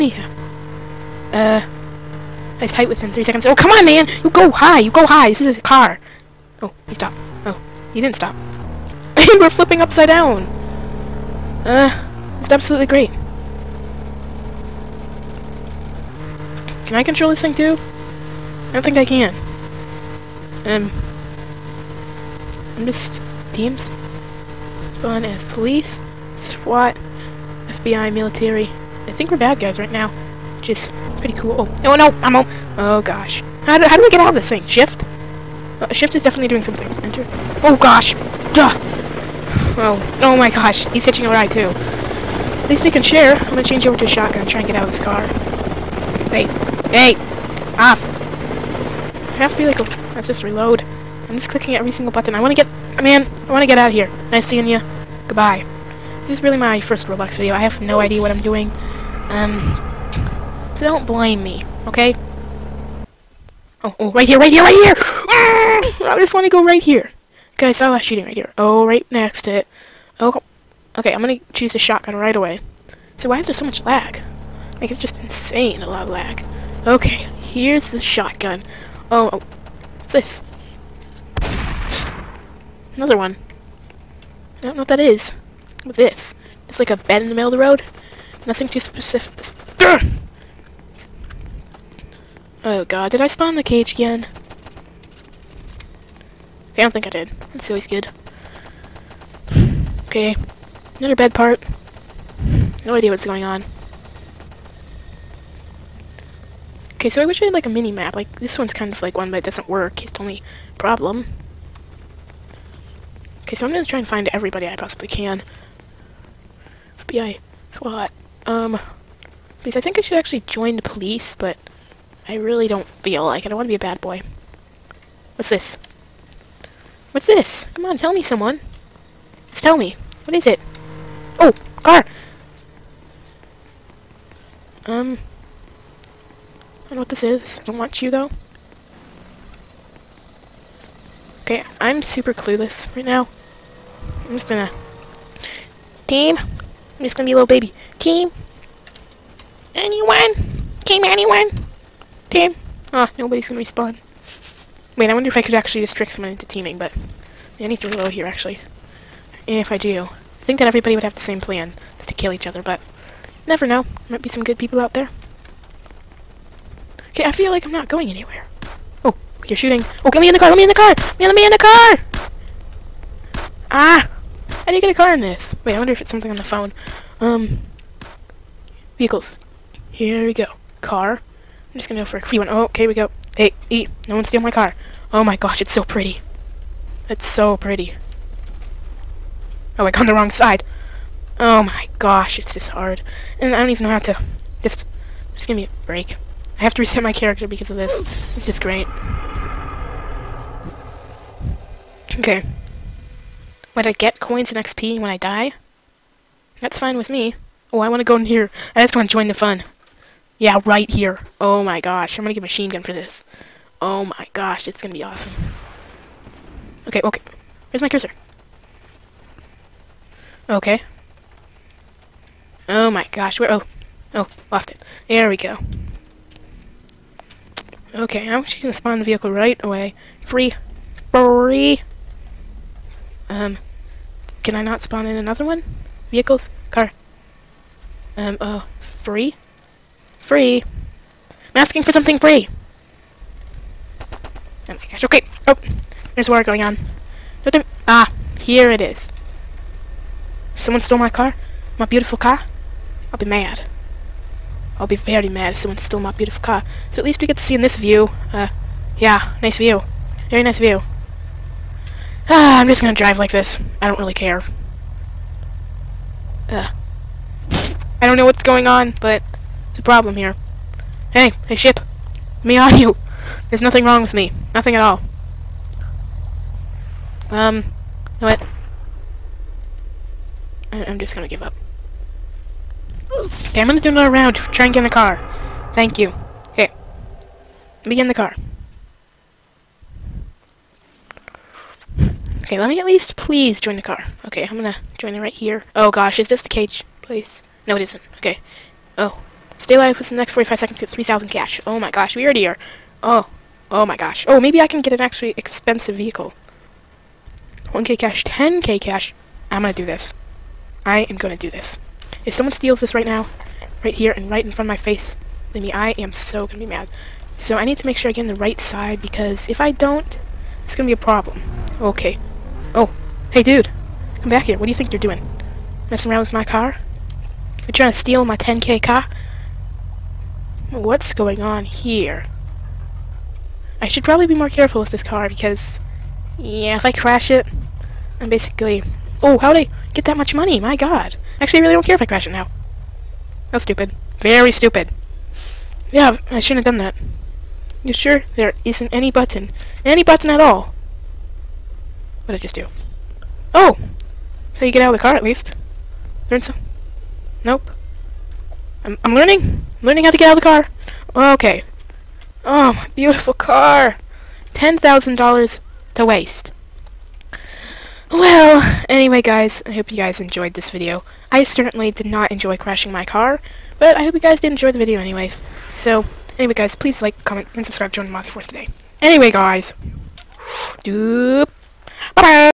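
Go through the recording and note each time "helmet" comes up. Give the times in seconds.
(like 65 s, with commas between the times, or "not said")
not said.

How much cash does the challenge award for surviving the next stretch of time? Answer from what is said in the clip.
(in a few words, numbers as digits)
3,000.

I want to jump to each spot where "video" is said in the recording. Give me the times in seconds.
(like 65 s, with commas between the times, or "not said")
57 s, 370 s, 374 s.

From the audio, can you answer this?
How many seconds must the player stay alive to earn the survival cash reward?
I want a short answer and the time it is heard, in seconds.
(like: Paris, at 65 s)
45, at 300 s.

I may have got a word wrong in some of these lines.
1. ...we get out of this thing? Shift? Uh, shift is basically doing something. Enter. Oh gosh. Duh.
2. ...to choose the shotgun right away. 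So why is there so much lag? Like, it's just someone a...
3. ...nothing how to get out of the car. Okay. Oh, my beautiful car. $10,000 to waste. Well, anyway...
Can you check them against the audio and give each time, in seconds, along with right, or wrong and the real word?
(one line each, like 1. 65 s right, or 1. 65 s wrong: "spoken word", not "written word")
1. 34 s wrong: "definitely", not "basically"
2. 71 s wrong: "insane", not "someone"
3. 359 s wrong: "learning", not "nothing".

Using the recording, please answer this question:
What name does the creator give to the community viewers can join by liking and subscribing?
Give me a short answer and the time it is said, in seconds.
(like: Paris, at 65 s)
Monster Force, at 378 s.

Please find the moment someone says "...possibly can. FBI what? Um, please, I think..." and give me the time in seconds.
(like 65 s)
114 s.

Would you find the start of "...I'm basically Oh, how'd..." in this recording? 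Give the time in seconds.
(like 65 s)
338 s.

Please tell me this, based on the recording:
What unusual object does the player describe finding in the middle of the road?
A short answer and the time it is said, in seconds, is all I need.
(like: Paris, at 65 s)
A bed, at 86 s.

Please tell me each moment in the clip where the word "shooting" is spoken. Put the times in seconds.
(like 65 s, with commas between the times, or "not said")
68 s, 169 s.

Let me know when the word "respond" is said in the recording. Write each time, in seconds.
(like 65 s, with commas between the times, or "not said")
153 s.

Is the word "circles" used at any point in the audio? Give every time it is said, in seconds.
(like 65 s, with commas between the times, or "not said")
not said.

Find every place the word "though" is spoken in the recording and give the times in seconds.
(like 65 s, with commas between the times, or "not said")
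138 s.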